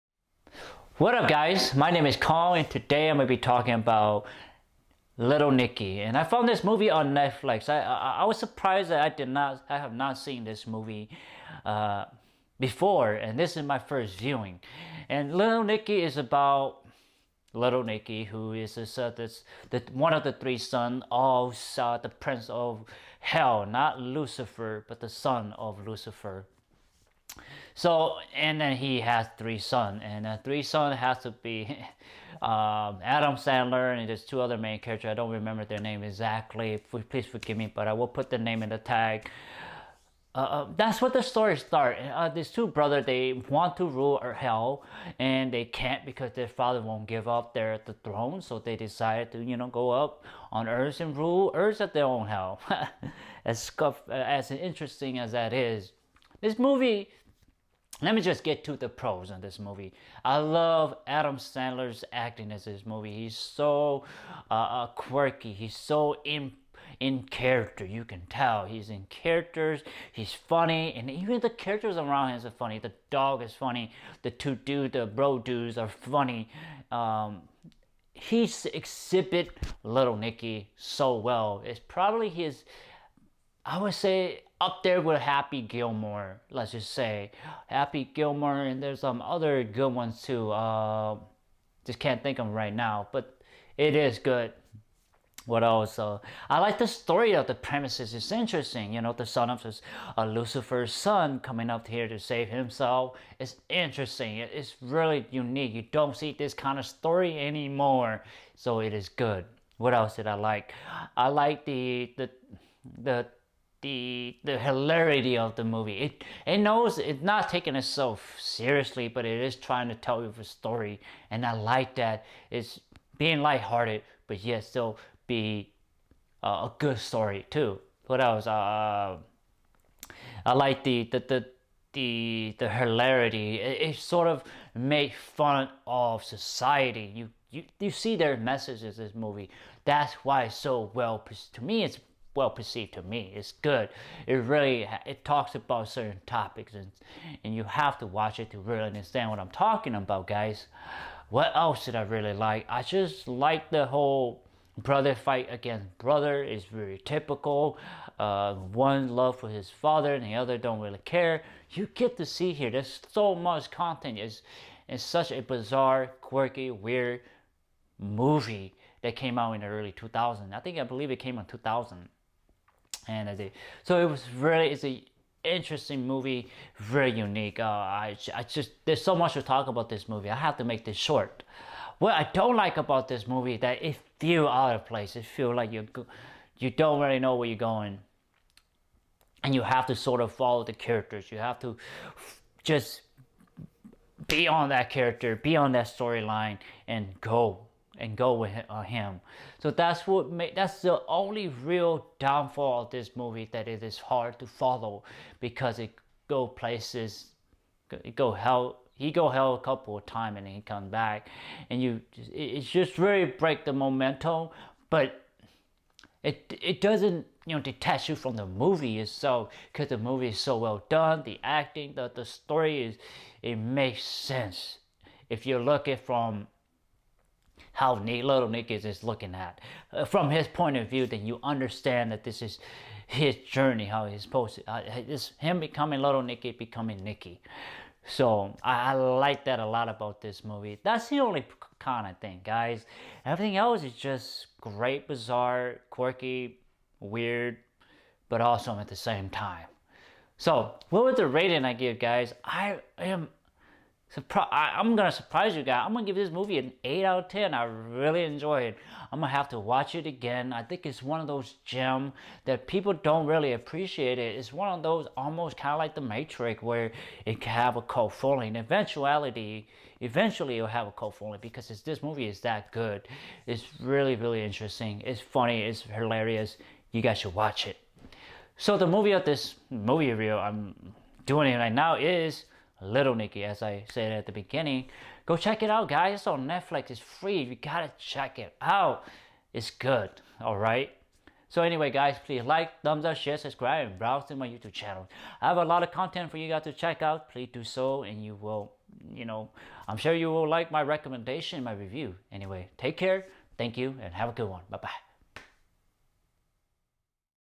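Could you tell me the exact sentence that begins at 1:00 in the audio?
I love Adam Sandler's acting in this movie.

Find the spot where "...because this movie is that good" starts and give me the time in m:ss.
4:31.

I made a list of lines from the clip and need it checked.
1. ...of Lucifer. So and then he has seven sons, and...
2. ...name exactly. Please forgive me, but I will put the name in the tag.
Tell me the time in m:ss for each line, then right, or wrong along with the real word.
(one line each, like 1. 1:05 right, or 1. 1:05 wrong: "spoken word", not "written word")
1. 0:25 wrong: "three", not "seven"
2. 0:35 right.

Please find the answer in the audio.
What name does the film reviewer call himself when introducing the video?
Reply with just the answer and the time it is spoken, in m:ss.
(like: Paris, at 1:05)
Kong, at 0:02.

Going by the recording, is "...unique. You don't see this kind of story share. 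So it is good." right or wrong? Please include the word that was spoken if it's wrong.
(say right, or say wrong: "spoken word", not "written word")
wrong: "anymore", not "share".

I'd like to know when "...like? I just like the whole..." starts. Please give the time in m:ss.
2:32.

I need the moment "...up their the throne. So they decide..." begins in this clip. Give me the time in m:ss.
0:47.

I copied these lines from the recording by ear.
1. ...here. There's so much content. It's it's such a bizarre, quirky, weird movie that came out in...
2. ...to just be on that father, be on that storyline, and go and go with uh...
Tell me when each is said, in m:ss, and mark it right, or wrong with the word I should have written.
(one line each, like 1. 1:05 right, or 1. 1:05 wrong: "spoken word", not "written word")
1. 2:42 right
2. 3:11 wrong: "character", not "father".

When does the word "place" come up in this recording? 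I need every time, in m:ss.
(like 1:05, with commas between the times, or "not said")
3:04, 3:26.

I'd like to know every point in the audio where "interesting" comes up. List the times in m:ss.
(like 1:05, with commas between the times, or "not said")
0:54, 1:38, 1:43, 2:55, 4:34.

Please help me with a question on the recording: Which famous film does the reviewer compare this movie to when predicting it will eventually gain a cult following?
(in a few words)
The Matrix.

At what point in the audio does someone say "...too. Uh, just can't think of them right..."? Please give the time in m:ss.
1:30.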